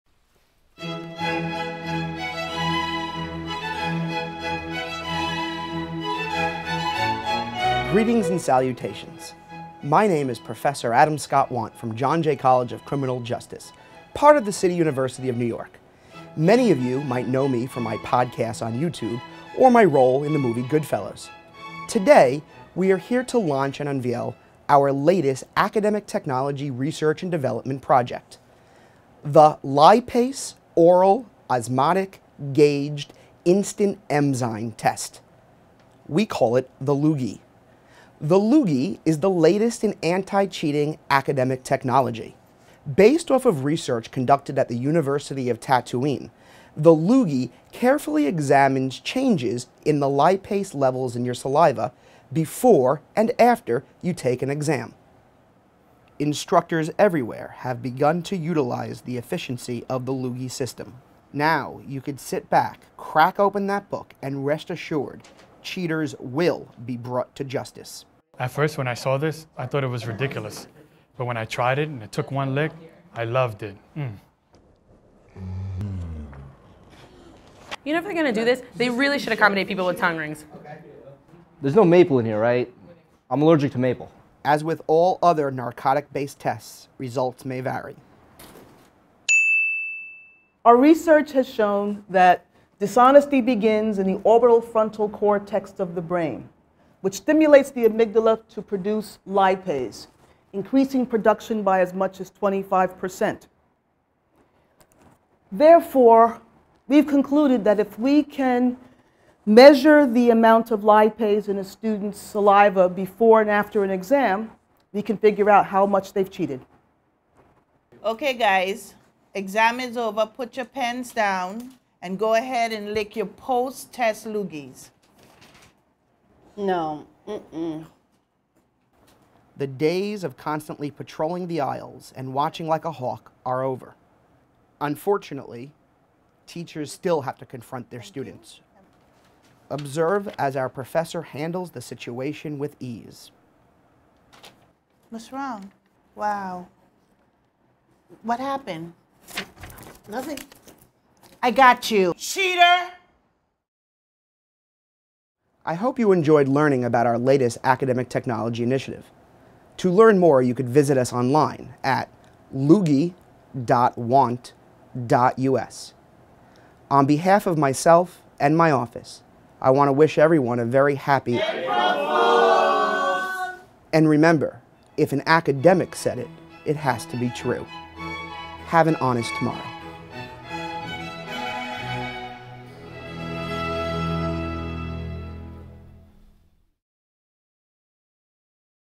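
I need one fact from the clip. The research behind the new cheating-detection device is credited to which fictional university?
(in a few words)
University of Tatooine.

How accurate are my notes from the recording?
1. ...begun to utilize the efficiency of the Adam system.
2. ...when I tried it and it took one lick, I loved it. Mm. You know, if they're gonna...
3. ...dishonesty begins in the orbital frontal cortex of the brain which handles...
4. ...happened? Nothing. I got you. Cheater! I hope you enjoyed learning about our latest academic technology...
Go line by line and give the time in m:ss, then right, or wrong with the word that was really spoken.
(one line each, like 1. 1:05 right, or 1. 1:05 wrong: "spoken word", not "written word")
1. 0:57 wrong: "Loogie", not "Adam"
2. 1:11 right
3. 1:32 wrong: "stimulates", not "handles"
4. 2:28 right.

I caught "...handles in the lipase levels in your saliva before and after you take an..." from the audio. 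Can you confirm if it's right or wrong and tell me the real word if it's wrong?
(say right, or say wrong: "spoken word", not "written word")
wrong: "changes", not "handles".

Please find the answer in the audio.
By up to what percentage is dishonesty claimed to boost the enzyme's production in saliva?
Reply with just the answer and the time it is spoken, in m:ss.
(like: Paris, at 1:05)
25%, at 1:42.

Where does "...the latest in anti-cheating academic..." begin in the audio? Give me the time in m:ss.
0:39.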